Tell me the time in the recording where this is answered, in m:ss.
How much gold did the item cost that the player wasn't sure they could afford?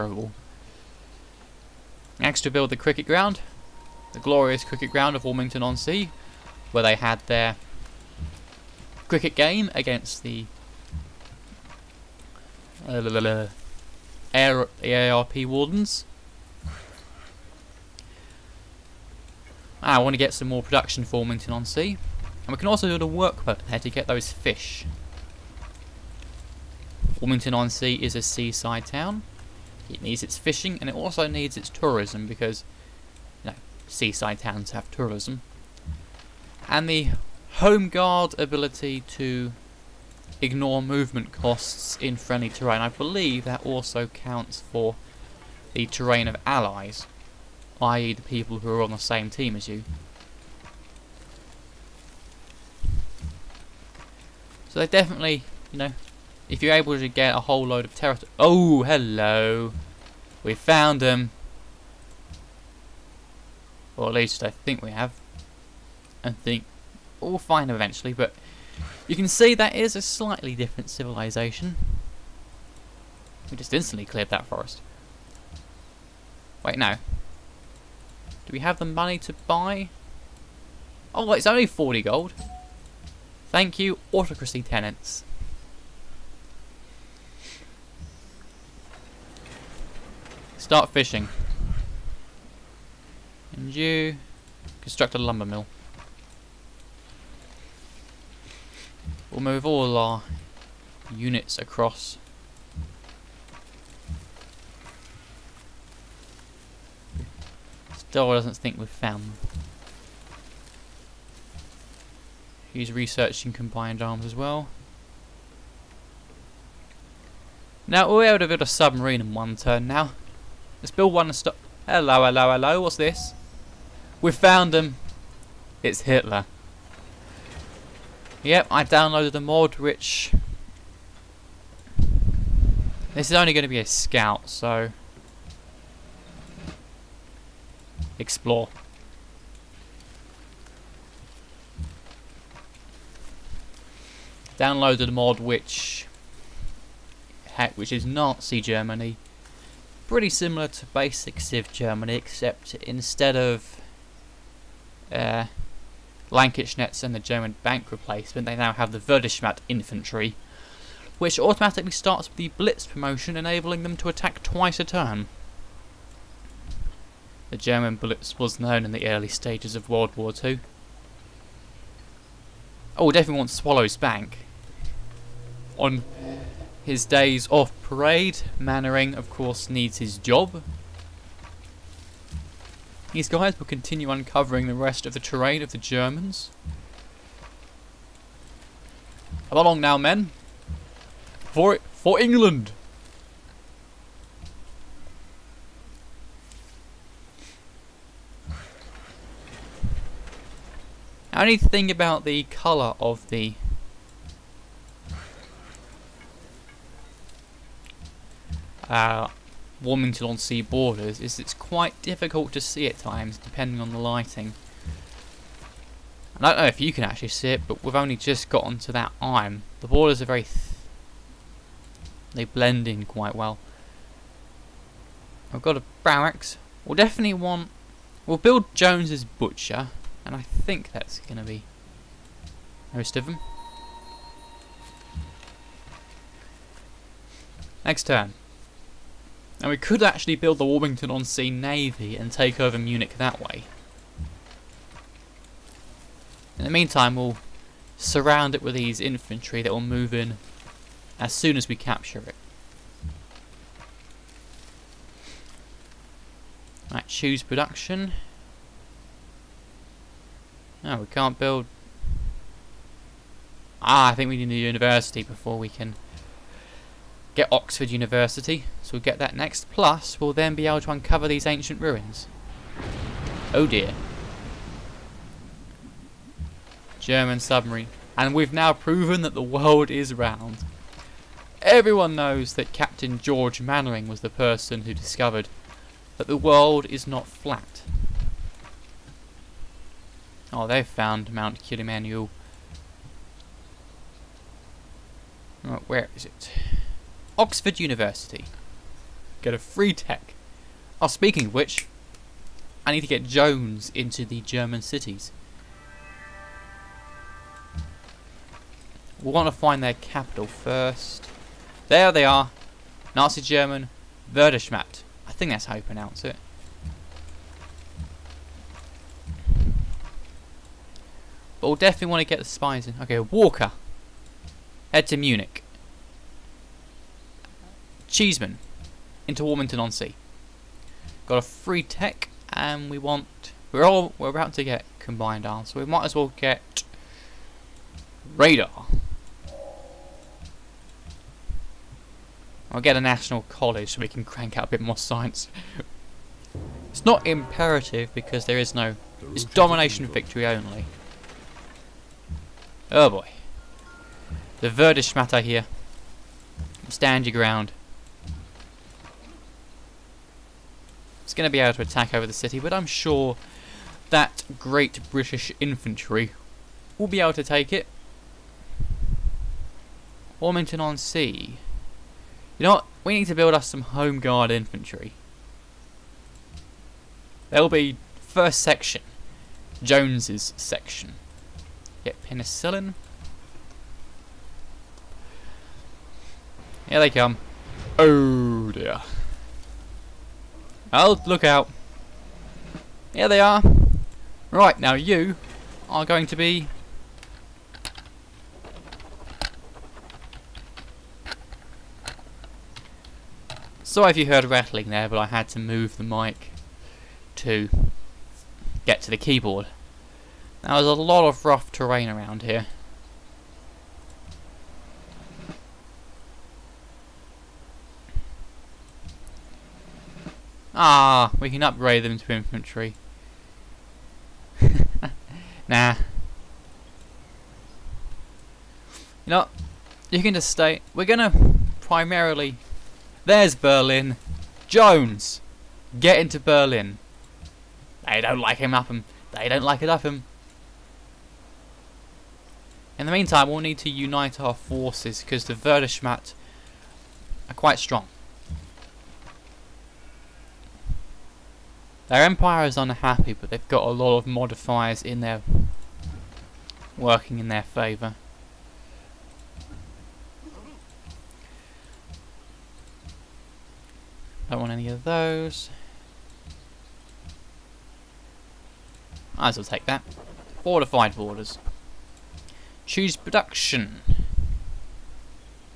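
1:21.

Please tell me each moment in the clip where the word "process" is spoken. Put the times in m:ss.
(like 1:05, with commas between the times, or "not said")
not said.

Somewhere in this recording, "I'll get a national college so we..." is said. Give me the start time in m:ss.
5:42.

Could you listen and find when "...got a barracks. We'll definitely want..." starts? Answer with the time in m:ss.
3:45.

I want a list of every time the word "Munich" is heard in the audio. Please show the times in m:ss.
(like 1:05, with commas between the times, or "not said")
4:02, 5:25.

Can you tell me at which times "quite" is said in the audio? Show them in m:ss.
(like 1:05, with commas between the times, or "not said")
3:31, 3:43, 7:27.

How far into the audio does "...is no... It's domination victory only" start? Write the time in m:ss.
5:48.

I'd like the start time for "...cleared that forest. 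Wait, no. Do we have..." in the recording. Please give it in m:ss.
1:14.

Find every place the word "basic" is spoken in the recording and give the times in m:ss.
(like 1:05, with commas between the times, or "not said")
2:30.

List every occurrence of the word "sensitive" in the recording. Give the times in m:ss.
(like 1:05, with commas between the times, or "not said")
not said.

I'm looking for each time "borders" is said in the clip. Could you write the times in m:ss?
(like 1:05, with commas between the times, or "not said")
3:30, 3:39, 7:51.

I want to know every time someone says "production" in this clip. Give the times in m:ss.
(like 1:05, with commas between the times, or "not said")
0:20, 4:17, 7:53.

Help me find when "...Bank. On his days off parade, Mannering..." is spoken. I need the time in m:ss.
2:53.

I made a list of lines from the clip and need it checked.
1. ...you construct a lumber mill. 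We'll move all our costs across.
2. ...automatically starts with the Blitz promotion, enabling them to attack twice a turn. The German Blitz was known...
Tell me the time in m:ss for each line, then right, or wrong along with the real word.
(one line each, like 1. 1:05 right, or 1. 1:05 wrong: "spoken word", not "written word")
1. 1:33 wrong: "units", not "costs"
2. 2:41 right.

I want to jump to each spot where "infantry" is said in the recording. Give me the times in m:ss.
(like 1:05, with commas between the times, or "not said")
2:39, 4:09, 6:05, 6:14, 7:02.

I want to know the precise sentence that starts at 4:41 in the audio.
Everyone knows that Captain George Mannering was the person who discovered that the world is not flat.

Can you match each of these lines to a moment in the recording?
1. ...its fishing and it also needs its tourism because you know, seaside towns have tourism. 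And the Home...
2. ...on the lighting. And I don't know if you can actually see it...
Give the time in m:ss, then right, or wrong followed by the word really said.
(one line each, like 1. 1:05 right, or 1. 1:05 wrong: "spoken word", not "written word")
1. 0:30 right
2. 3:33 right.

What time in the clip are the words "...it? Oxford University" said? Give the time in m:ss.
4:56.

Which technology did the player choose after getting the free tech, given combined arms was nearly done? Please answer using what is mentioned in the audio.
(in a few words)
Radar.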